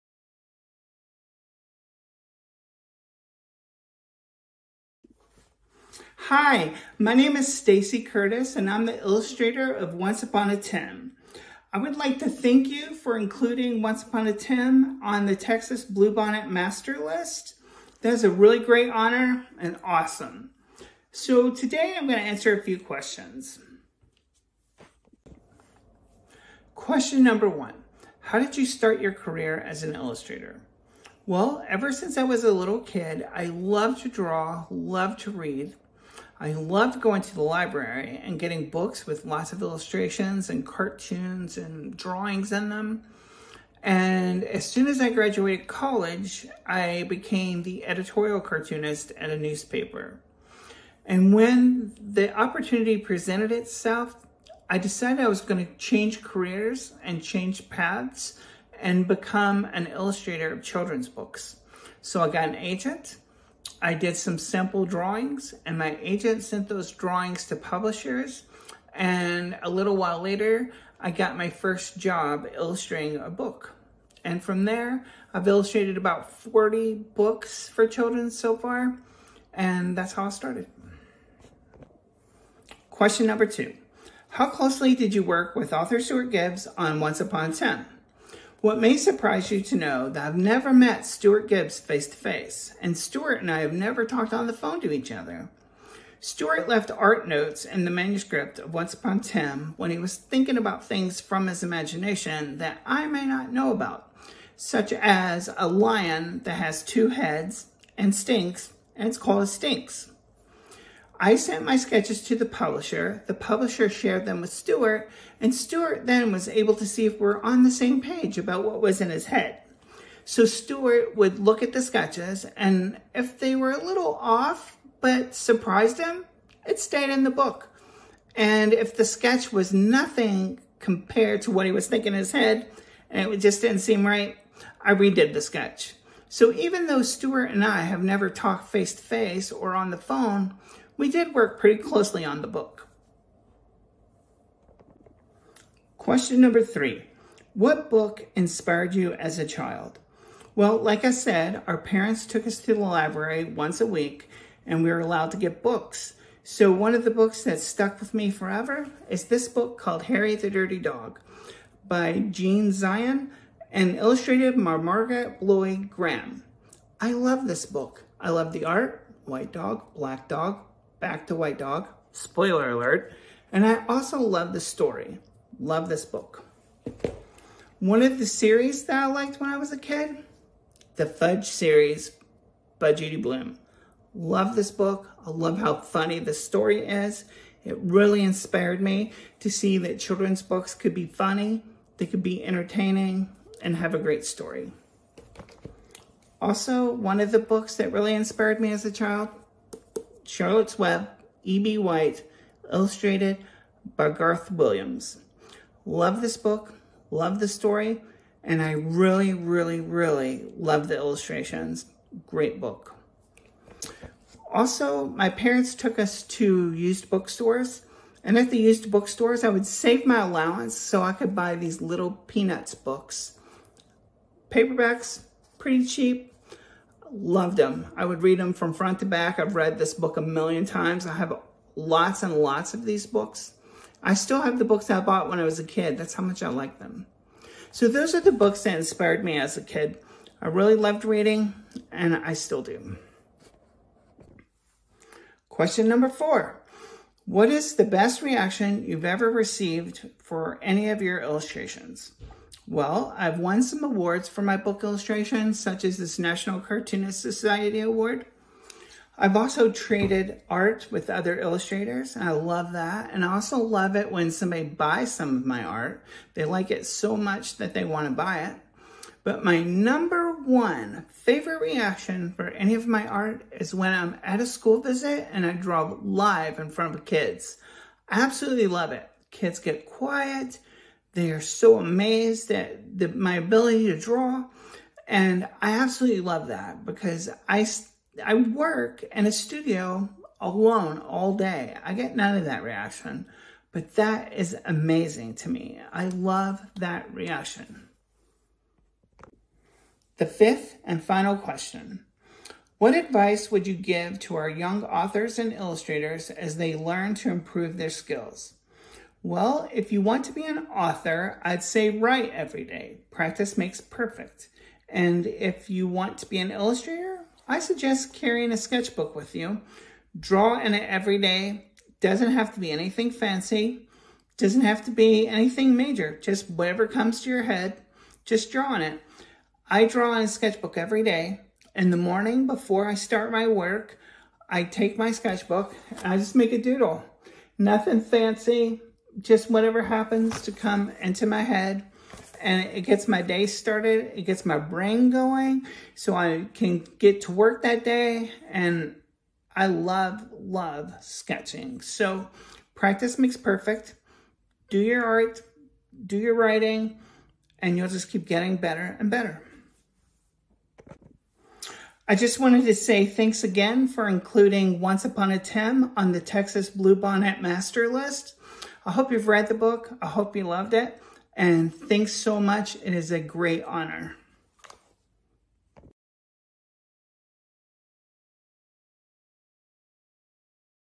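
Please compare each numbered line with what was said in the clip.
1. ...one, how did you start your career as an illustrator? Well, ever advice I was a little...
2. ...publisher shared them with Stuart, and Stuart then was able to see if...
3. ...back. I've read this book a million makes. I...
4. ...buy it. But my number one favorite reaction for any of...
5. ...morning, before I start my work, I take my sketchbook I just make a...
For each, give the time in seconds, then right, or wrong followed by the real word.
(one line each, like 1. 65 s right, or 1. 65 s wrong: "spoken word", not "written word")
1. 27 s wrong: "since", not "advice"
2. 113 s right
3. 229 s wrong: "times", not "makes"
4. 268 s right
5. 331 s right.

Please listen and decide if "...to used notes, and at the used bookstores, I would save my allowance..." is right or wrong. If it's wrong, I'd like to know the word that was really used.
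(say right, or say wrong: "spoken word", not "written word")
wrong: "bookstores", not "notes".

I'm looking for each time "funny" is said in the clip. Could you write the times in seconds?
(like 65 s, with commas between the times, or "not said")
185 s, 191 s.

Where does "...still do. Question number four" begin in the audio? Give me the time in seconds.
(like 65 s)
242 s.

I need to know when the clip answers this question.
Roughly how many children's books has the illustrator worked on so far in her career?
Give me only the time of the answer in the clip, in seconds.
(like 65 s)
75 s.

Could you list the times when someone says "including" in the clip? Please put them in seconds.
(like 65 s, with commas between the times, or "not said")
13 s, 364 s.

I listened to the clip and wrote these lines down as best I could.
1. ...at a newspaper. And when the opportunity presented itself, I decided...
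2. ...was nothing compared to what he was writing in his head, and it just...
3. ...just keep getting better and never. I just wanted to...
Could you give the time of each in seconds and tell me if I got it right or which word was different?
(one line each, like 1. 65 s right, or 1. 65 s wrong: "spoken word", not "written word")
1. 49 s right
2. 129 s wrong: "thinking", not "writing"
3. 357 s wrong: "better", not "never".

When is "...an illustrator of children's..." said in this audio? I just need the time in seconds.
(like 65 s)
59 s.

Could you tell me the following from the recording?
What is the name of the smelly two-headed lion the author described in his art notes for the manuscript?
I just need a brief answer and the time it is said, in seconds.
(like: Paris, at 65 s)
Stinx, at 109 s.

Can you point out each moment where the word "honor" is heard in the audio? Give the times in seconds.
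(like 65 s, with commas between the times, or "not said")
18 s, 373 s.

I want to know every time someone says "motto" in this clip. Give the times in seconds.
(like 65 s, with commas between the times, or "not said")
not said.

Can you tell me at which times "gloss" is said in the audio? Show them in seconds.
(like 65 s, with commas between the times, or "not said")
not said.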